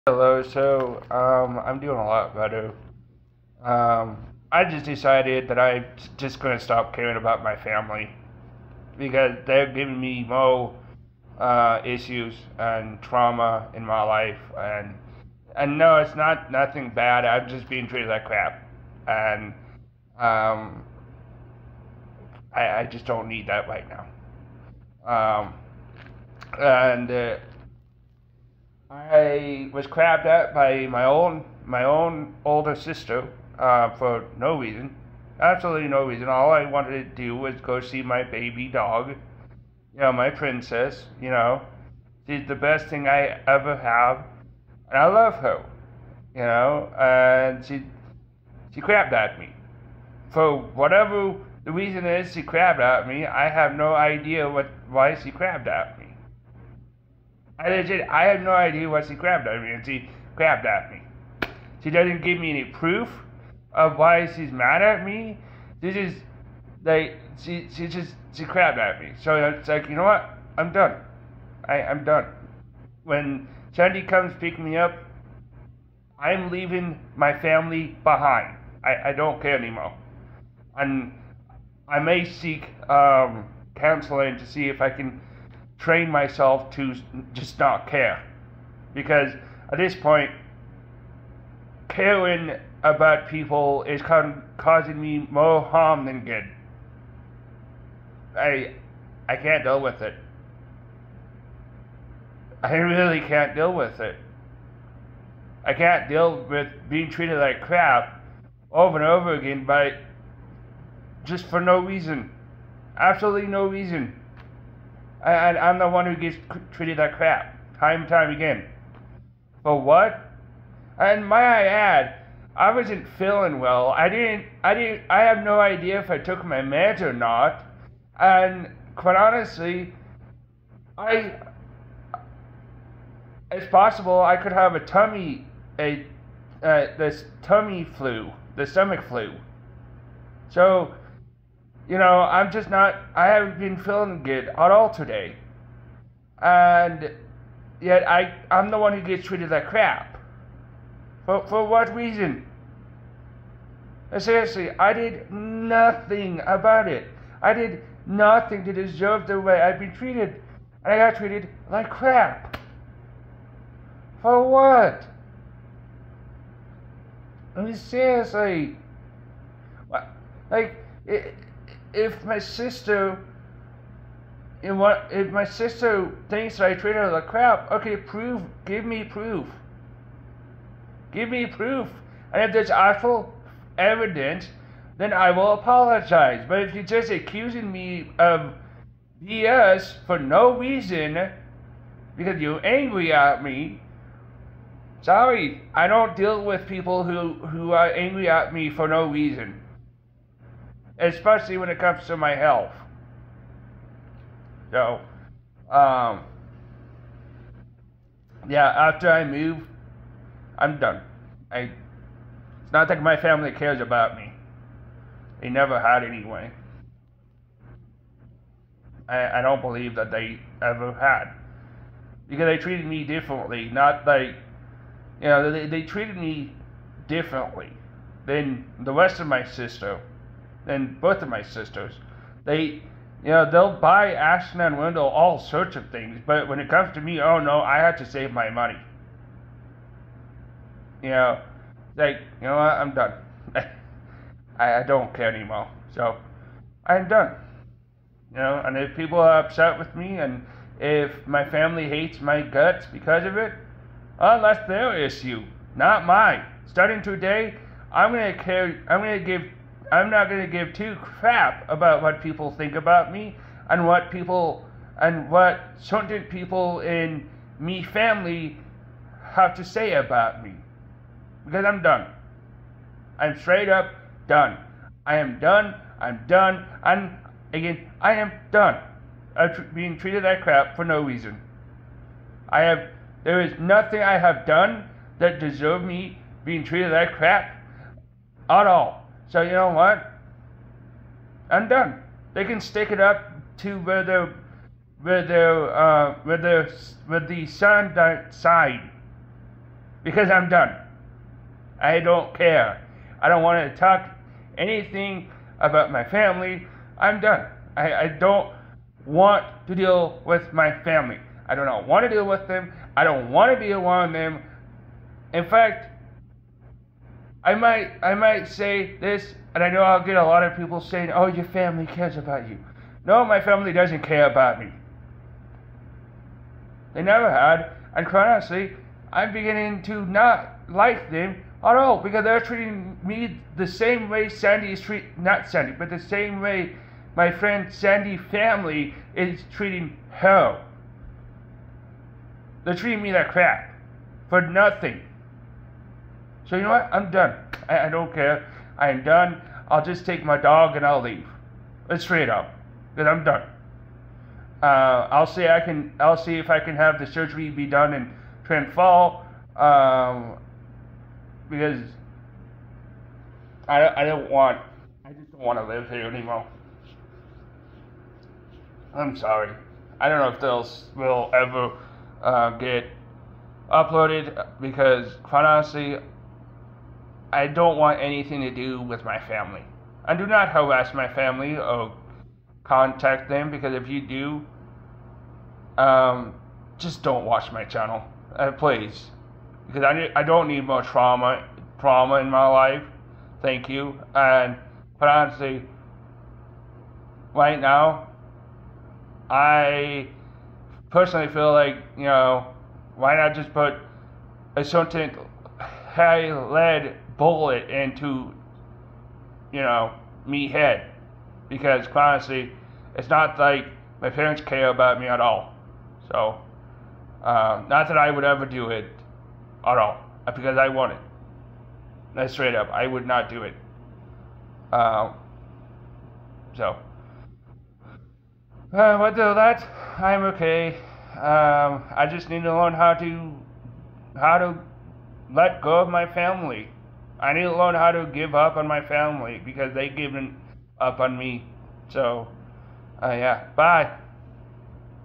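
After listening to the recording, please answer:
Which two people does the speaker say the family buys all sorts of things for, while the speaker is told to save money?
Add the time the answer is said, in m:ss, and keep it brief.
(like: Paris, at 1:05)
Ashton and Wendell, at 3:54.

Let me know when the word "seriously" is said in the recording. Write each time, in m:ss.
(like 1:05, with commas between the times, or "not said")
2:34, 2:47.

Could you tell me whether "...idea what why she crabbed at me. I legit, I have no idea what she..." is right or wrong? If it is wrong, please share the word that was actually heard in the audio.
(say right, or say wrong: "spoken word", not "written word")
right.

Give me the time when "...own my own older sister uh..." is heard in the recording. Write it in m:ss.
0:31.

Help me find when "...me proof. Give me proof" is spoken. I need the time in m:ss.
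2:58.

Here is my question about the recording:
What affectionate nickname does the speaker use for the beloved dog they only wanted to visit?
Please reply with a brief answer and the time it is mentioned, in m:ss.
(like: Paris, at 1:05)
Princess, at 0:40.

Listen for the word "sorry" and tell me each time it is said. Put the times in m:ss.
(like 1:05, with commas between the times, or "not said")
3:15, 6:09.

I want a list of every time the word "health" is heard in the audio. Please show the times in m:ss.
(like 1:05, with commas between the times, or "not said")
3:22.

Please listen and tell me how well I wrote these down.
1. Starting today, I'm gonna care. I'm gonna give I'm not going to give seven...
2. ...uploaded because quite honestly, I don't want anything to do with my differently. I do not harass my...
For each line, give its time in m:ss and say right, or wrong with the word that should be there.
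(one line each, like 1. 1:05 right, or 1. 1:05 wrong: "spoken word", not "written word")
1. 4:16 wrong: "two", not "seven"
2. 6:13 wrong: "family", not "differently".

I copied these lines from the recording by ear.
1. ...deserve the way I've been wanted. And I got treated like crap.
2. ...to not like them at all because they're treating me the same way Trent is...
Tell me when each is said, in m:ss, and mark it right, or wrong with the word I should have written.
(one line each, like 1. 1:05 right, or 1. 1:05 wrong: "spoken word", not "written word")
1. 2:38 wrong: "treated", not "wanted"
2. 5:29 wrong: "Sandy", not "Trent".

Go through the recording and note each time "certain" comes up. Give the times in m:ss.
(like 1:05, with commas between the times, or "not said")
4:25, 6:44.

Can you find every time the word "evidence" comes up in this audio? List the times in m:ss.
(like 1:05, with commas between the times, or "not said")
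3:03.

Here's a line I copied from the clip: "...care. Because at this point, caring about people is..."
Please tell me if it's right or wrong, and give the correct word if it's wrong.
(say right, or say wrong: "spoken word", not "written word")
right.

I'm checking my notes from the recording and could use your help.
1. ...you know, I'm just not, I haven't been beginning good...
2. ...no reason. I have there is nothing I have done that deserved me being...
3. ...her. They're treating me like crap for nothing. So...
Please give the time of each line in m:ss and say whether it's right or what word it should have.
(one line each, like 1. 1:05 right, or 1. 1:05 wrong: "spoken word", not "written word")
1. 2:21 wrong: "feeling", not "beginning"
2. 4:40 right
3. 5:40 right.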